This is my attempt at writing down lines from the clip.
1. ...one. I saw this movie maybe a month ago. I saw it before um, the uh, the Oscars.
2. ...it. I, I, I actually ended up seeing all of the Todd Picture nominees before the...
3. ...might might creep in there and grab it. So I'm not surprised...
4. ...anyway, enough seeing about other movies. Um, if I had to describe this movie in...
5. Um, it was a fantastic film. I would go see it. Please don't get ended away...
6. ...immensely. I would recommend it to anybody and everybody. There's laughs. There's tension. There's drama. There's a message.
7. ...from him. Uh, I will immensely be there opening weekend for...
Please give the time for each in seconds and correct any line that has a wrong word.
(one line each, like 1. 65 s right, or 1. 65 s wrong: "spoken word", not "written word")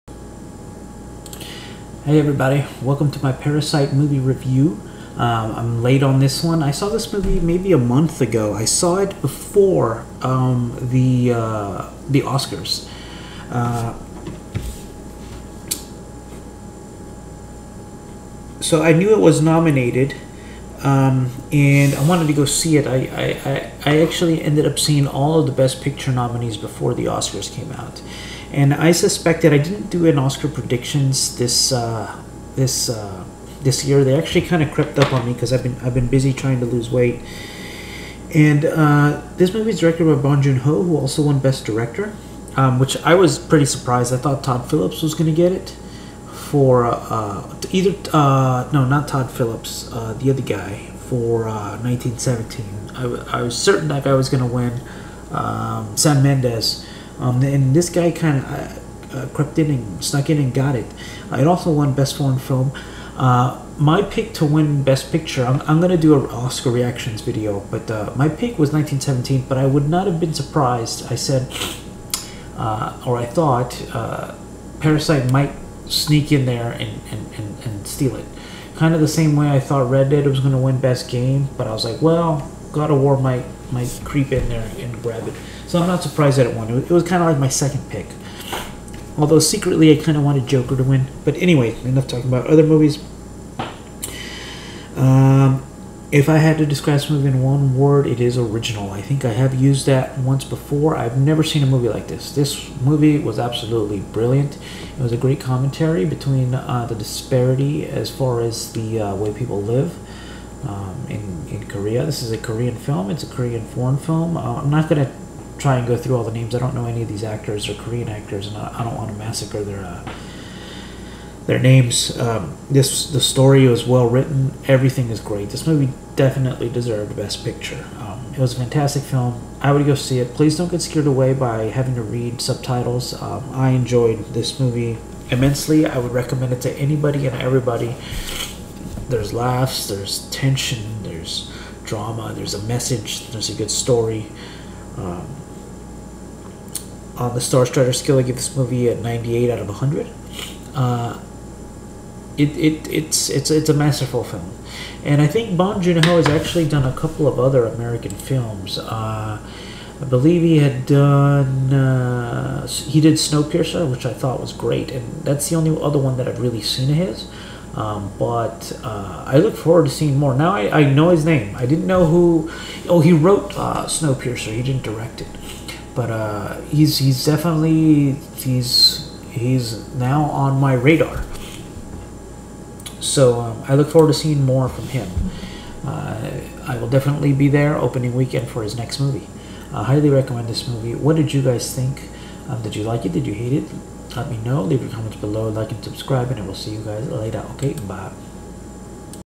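1. 6 s right
2. 22 s wrong: "Best", not "Todd"
3. 83 s right
4. 91 s wrong: "talking", not "seeing"
5. 127 s wrong: "scared", not "ended"
6. 135 s right
7. 184 s wrong: "definitely", not "immensely".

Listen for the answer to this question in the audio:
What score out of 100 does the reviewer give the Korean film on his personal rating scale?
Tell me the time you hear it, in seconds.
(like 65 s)
148 s.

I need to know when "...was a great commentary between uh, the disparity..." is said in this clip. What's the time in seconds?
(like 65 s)
105 s.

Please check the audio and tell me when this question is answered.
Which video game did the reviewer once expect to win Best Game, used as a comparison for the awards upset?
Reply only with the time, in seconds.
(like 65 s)
79 s.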